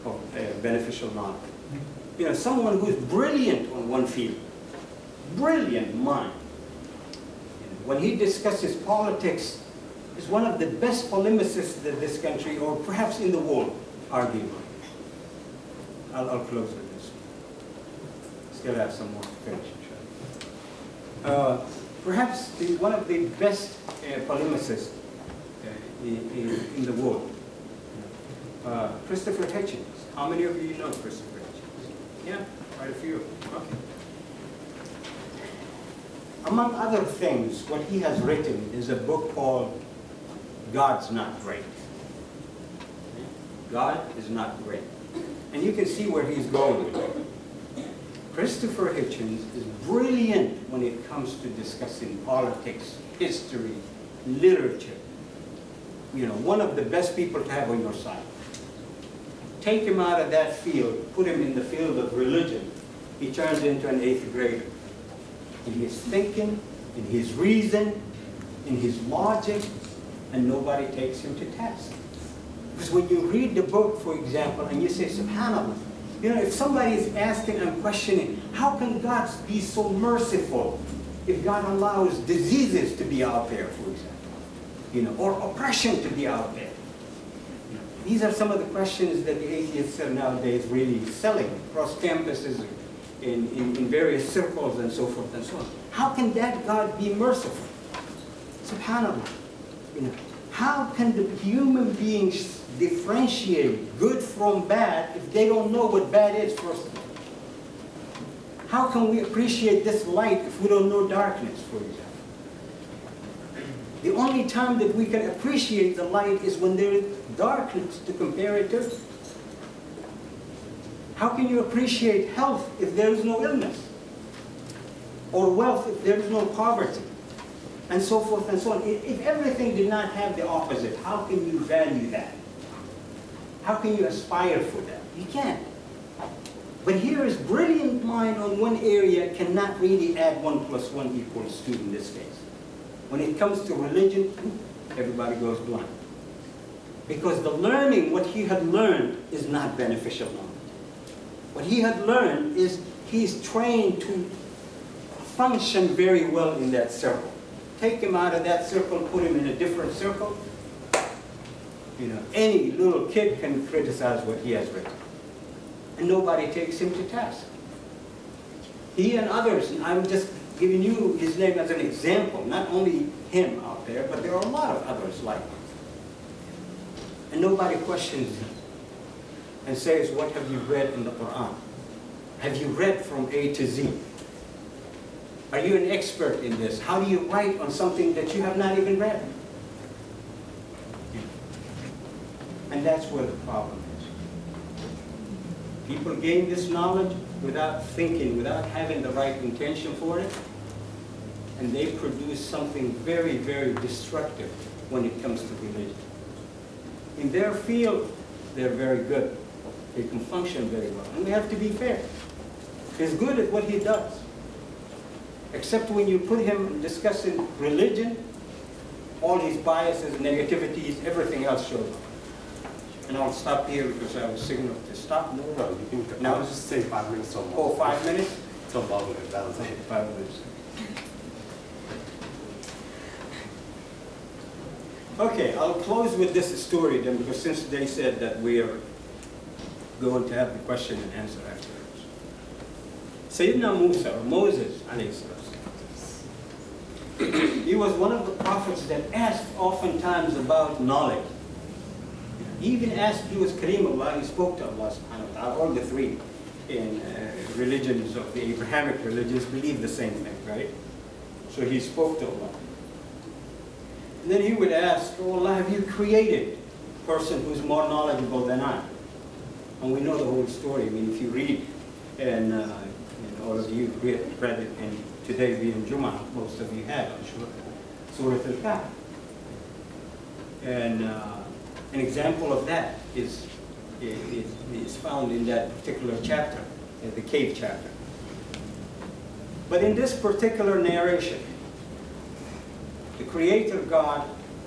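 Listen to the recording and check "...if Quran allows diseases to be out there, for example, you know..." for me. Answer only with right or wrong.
wrong.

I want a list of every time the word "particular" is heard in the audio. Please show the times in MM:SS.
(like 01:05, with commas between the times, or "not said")
04:45, 04:50.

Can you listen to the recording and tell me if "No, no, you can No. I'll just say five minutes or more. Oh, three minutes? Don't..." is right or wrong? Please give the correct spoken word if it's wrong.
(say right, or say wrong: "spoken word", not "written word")
wrong: "five", not "three".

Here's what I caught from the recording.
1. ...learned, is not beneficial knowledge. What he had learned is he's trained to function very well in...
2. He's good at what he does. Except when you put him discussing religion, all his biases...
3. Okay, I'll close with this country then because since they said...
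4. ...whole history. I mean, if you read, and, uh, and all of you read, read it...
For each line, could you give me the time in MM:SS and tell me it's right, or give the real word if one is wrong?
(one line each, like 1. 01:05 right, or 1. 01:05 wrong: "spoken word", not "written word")
1. 02:28 right
2. 03:32 right
3. 03:55 wrong: "story", not "country"
4. 04:30 wrong: "story", not "history".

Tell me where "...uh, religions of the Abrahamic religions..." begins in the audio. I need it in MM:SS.
04:17.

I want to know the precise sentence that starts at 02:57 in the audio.
And nobody questions him and says, what have you read in the Quran?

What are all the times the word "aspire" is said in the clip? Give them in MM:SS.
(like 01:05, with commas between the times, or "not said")
02:14.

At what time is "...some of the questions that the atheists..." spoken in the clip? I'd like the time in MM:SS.
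01:28.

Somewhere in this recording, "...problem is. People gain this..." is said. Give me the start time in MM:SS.
03:13.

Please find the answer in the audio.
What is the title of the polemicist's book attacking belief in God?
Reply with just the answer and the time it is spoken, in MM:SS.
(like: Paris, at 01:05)
God's Not Great, at 00:40.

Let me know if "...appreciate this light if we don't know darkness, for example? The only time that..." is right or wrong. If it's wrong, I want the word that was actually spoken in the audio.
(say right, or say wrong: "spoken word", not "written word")
right.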